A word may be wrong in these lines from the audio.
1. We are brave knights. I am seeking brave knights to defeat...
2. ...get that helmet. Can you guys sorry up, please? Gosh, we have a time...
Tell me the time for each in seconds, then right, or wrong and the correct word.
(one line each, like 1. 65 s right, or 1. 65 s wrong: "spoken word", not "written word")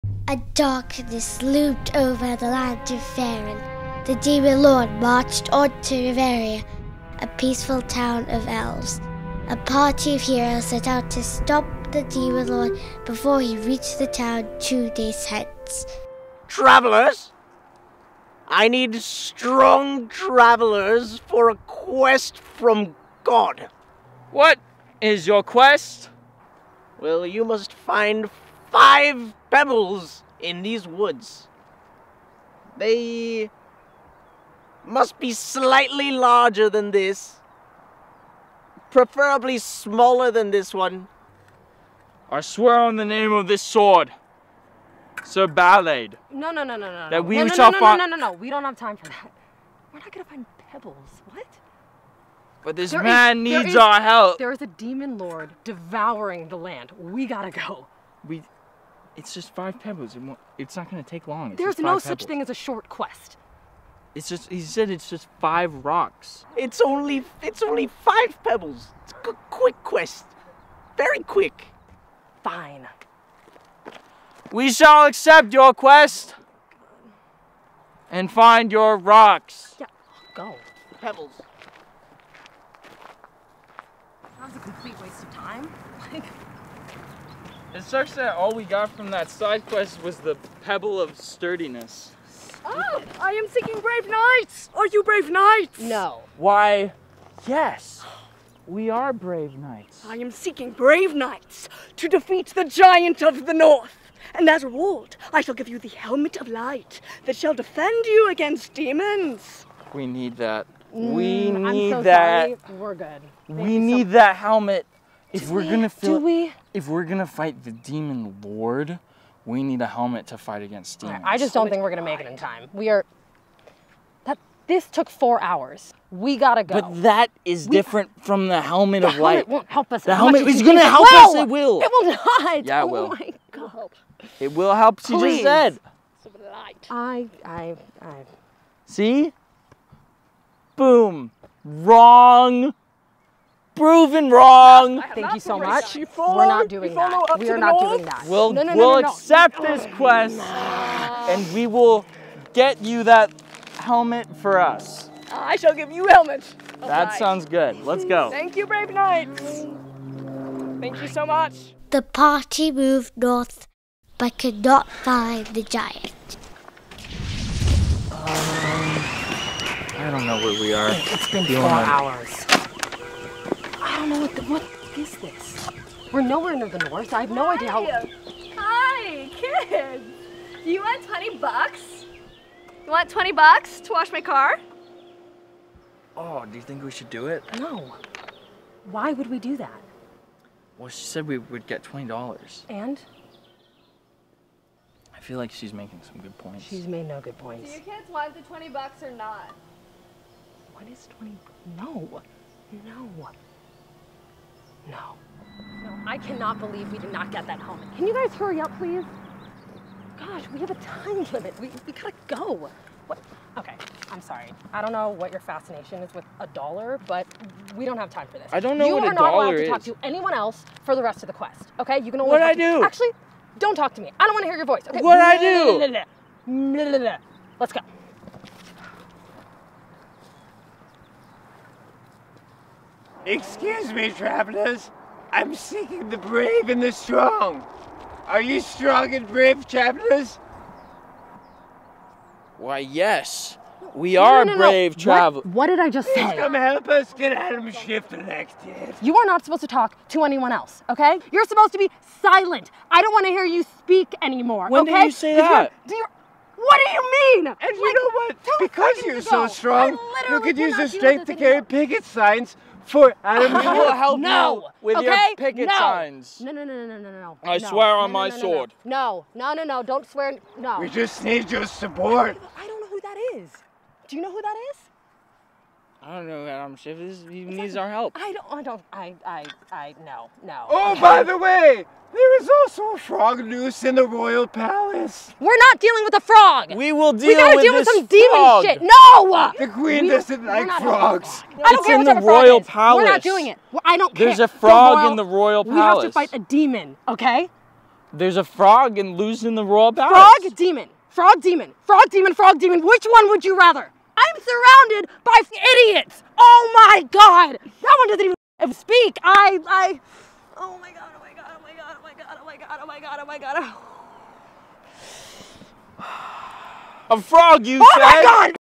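1. 98 s right
2. 207 s wrong: "hurry", not "sorry".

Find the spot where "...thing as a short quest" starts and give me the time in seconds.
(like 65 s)
62 s.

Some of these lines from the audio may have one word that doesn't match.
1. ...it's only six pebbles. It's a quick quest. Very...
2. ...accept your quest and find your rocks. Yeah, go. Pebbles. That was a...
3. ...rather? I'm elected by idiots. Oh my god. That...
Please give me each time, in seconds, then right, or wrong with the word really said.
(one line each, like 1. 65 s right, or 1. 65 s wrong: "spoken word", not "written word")
1. 67 s wrong: "five", not "six"
2. 75 s right
3. 303 s wrong: "surrounded", not "elected".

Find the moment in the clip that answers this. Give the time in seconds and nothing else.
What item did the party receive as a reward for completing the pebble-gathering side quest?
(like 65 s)
90 s.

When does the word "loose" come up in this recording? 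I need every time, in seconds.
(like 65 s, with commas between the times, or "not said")
283 s.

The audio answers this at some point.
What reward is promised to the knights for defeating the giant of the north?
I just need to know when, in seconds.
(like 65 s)
105 s.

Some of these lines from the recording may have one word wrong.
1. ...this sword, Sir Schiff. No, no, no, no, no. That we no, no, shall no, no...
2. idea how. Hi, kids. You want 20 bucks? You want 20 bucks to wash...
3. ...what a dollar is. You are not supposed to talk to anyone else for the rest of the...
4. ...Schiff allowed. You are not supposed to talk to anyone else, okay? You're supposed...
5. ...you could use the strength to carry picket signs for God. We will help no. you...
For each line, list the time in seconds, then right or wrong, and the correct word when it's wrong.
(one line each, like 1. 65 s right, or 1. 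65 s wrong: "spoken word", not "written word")
1. 43 s wrong: "Ballade", not "Schiff"
2. 177 s right
3. 218 s wrong: "allowed", not "supposed"
4. 247 s wrong: "elected", not "allowed"
5. 260 s wrong: "Adam", not "God".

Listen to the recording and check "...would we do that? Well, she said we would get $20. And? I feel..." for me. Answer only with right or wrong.
right.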